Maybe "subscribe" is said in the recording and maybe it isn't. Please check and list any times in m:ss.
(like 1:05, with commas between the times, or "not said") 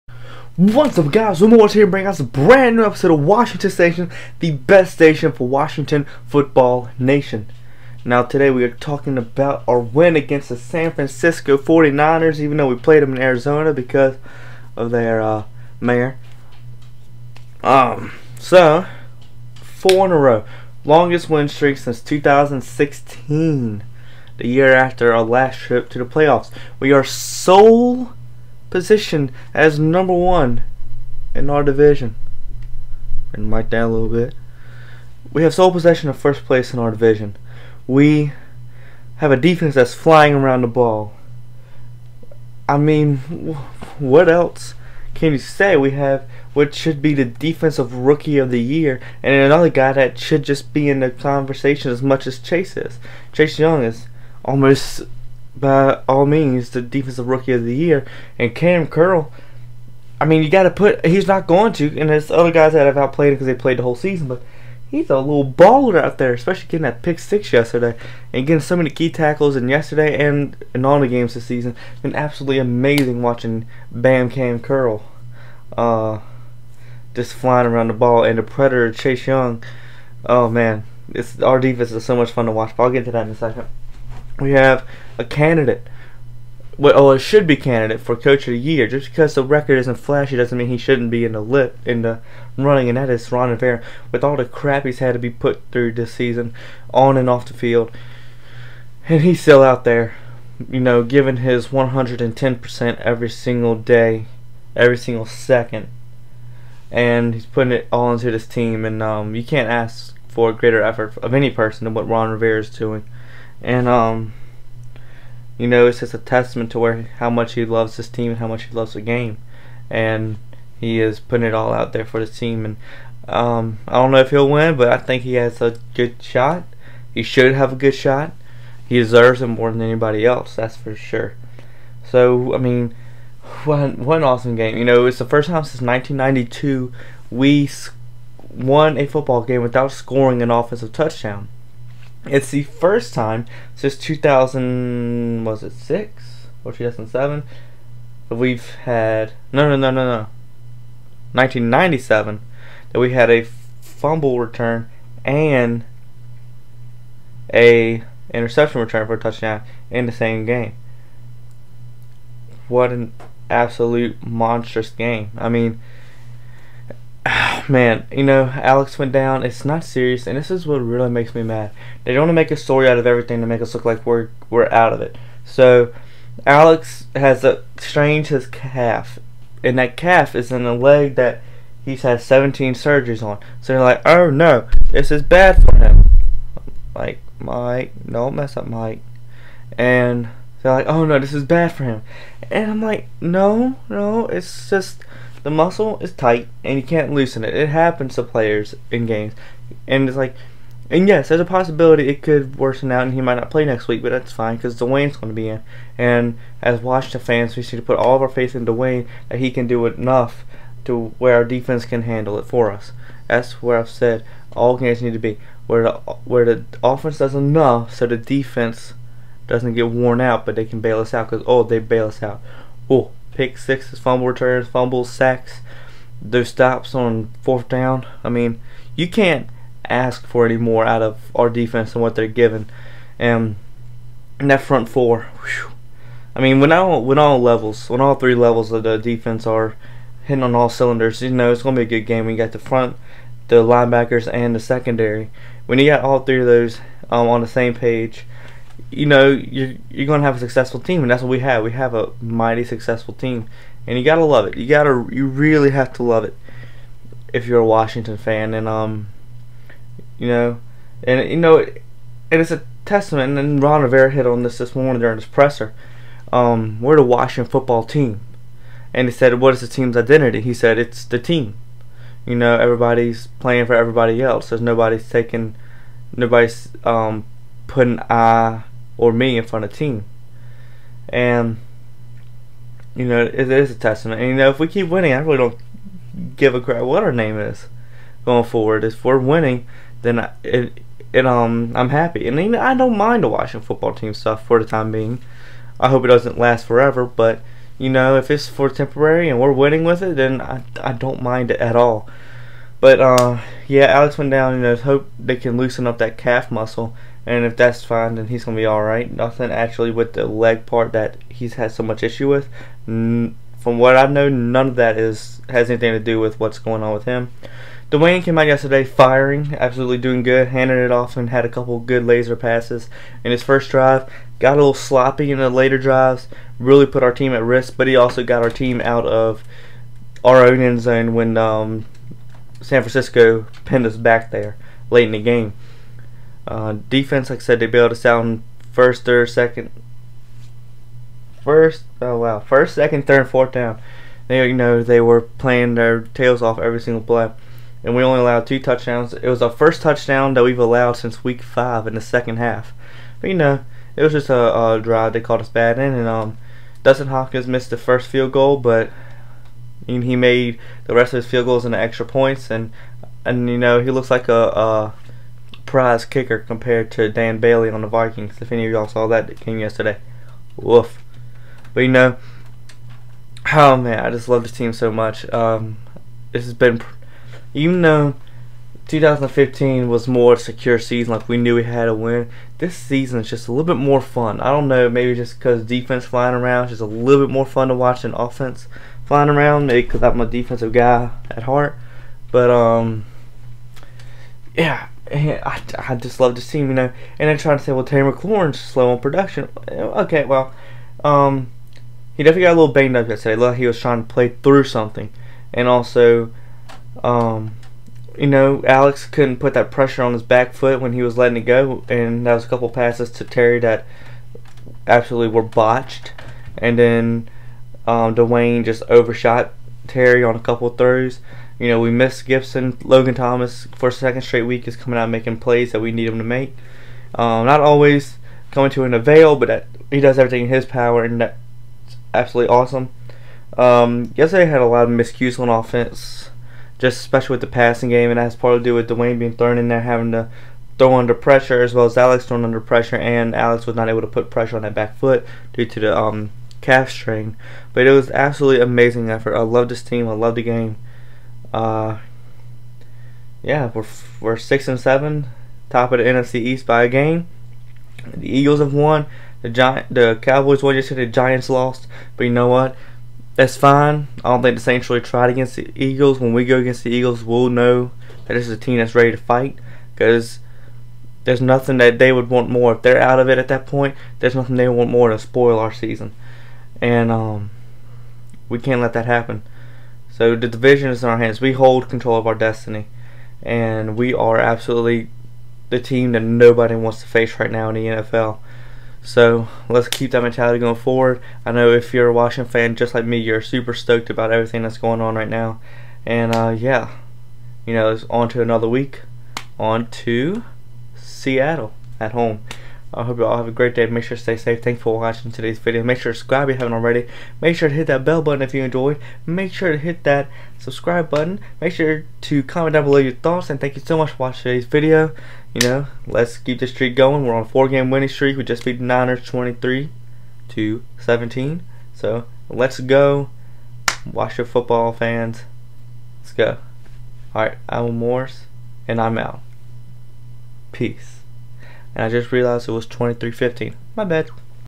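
8:26, 8:30.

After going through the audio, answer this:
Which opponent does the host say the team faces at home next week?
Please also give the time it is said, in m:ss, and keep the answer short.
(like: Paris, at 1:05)
Seattle, at 8:20.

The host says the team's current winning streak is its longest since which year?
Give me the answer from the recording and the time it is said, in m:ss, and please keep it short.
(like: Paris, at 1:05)
2016, at 0:22.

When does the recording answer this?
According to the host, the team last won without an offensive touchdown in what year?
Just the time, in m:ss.
2:15.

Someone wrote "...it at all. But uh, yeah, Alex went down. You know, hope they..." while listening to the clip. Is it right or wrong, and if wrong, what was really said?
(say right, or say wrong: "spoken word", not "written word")
right.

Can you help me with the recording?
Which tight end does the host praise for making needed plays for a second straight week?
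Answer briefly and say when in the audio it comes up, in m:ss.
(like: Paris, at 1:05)
Logan Thomas, at 7:02.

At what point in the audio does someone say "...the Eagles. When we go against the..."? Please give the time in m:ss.
7:45.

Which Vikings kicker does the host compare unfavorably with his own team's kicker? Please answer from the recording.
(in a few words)
Dan Bailey.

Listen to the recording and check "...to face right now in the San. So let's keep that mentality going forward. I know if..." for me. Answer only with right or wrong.
wrong.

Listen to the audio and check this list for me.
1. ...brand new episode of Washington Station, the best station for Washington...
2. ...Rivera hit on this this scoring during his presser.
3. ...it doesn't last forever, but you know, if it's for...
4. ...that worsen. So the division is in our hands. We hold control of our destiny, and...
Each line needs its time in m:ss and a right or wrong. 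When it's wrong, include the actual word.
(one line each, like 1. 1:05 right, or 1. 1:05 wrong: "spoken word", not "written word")
1. 0:02 right
2. 4:23 wrong: "morning", not "scoring"
3. 4:56 right
4. 7:58 wrong: "happen", not "worsen".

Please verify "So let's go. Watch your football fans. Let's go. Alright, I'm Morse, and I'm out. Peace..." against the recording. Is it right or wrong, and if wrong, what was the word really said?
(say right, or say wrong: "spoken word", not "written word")
right.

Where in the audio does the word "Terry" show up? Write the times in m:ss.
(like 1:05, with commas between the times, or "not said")
6:37, 6:53, 6:59.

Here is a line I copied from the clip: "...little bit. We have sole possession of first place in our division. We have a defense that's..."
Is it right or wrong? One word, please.
right.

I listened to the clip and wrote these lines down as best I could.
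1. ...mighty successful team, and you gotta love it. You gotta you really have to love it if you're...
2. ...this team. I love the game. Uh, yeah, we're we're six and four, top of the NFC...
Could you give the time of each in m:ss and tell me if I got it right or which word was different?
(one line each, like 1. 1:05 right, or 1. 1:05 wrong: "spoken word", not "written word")
1. 4:12 right
2. 7:29 wrong: "seven", not "four".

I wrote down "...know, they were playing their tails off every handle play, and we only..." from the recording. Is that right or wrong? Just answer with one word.
wrong.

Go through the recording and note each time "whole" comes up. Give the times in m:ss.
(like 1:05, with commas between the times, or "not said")
1:03.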